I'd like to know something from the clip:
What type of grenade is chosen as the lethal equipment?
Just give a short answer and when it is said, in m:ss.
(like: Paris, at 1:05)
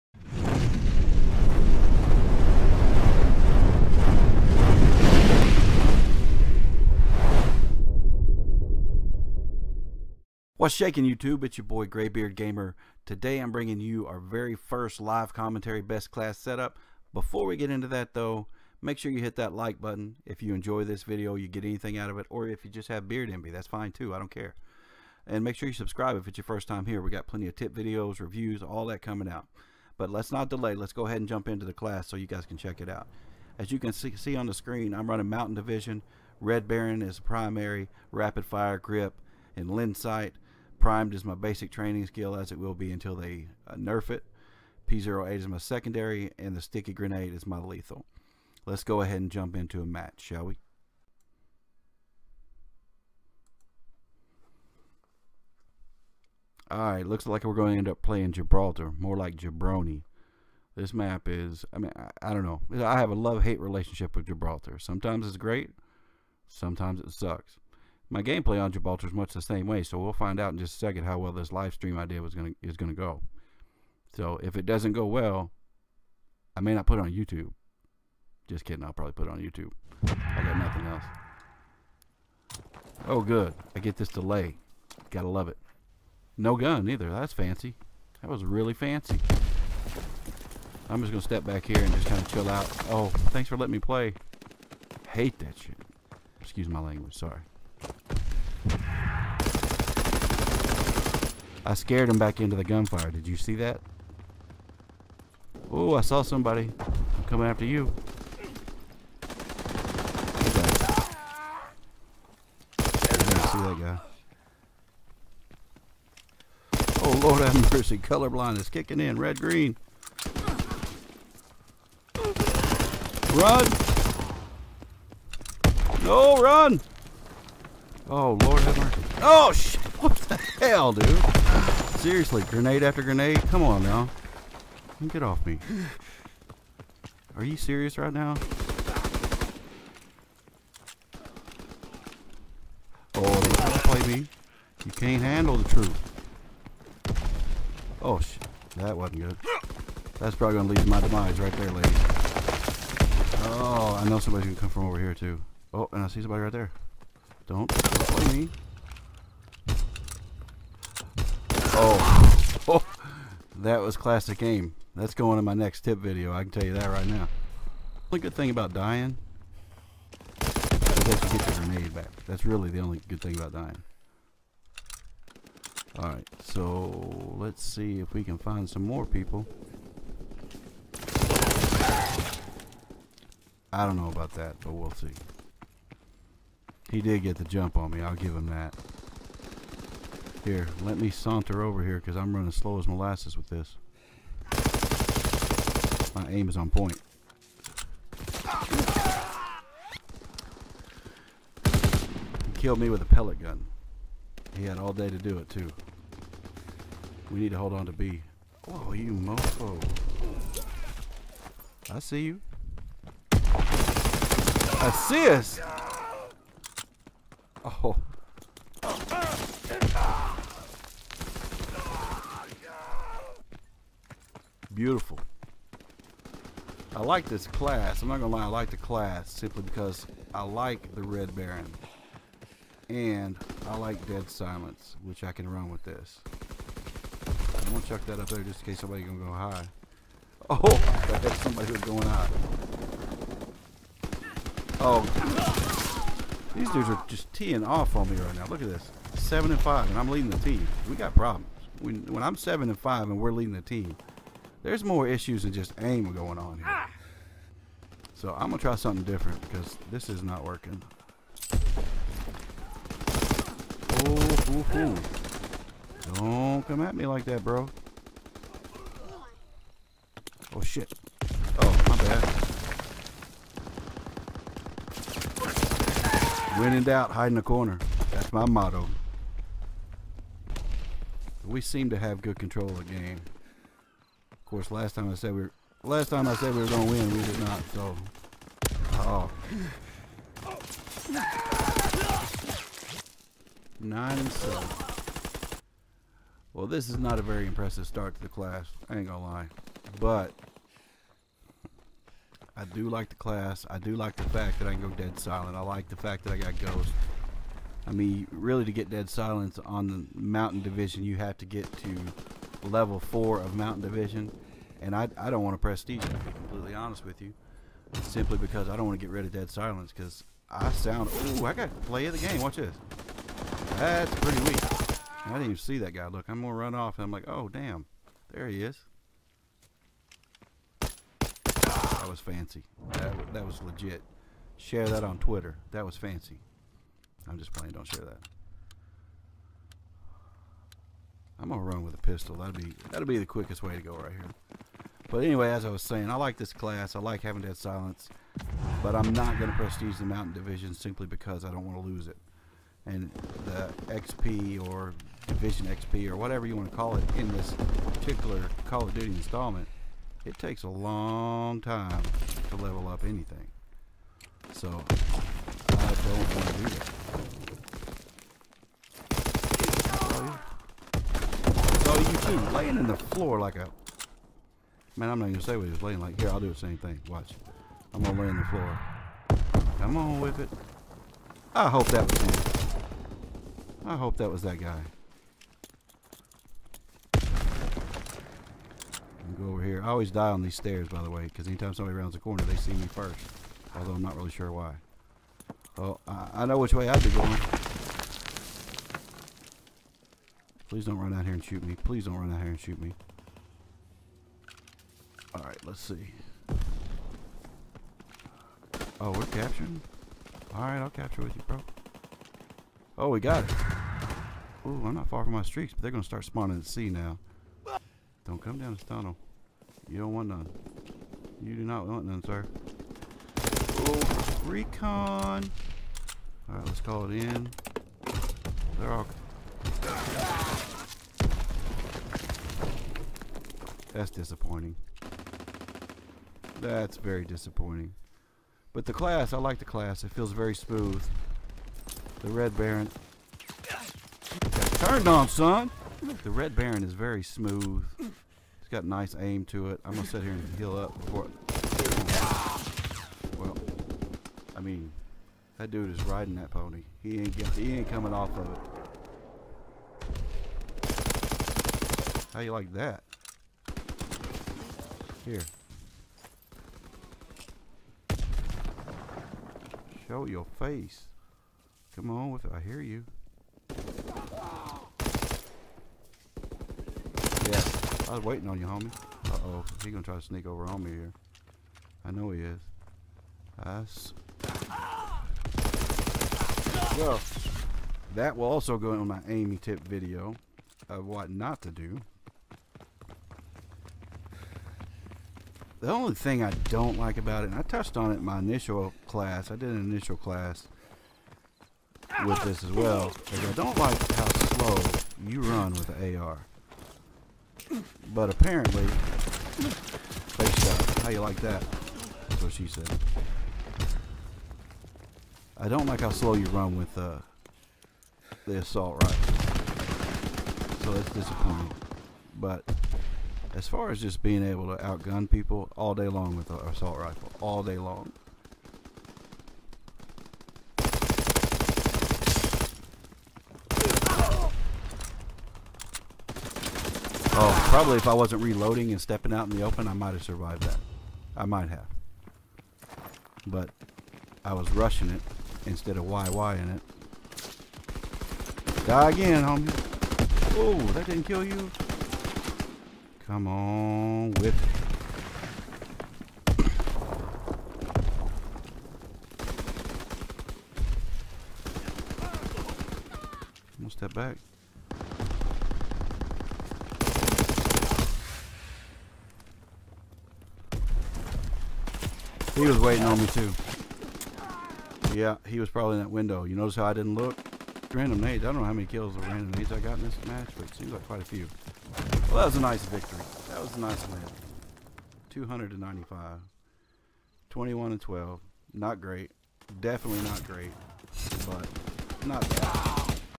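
sticky grenade, at 0:46.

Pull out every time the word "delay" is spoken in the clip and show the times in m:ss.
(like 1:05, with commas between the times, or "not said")
0:30, 1:24.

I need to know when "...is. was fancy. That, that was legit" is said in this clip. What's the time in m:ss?
5:28.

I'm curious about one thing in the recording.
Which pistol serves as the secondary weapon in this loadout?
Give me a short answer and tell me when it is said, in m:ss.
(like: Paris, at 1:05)
P08, at 0:44.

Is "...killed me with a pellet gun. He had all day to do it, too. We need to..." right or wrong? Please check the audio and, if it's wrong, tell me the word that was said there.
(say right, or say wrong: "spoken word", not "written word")
right.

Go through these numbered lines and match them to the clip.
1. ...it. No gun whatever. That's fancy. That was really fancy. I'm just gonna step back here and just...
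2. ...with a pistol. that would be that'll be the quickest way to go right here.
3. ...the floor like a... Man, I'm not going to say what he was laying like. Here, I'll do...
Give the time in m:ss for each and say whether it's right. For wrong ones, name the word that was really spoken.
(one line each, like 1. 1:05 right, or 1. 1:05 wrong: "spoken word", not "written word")
1. 1:25 wrong: "either", not "whatever"
2. 5:41 right
3. 6:12 right.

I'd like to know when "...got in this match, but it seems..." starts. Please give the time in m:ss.
9:39.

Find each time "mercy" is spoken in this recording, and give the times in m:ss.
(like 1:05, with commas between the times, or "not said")
1:57, 2:08.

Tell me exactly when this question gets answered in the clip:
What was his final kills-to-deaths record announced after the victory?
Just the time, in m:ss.
9:47.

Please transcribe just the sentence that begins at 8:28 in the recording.
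But apparently, face How you like that?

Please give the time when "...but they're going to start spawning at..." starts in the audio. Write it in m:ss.
6:55.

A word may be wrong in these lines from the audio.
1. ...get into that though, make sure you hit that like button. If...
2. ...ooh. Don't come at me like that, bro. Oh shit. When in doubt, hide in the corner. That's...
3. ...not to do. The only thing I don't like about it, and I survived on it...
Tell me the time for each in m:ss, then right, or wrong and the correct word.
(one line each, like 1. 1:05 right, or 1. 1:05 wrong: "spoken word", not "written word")
1. 0:17 right
2. 4:24 right
3. 8:11 wrong: "touched", not "survived".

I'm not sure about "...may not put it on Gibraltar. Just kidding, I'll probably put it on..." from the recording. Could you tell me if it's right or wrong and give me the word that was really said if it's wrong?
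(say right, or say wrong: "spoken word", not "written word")
wrong: "YouTube", not "Gibraltar".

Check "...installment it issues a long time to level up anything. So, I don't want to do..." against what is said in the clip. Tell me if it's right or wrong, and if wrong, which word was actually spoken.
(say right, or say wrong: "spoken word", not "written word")
wrong: "takes", not "issues".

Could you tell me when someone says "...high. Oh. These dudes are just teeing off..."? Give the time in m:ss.
4:02.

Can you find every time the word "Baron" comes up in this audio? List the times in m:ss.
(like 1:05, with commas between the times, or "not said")
0:36, 3:51, 7:22, 7:26.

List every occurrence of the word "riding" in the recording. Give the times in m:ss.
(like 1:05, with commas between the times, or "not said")
7:36.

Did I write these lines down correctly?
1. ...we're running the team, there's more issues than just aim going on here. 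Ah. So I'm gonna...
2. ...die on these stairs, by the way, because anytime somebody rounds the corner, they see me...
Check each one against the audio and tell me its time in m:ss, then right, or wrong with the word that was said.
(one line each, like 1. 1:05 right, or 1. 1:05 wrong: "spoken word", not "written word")
1. 4:13 wrong: "leading", not "running"
2. 6:30 right.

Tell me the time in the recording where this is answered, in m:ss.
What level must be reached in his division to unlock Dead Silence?
5:12.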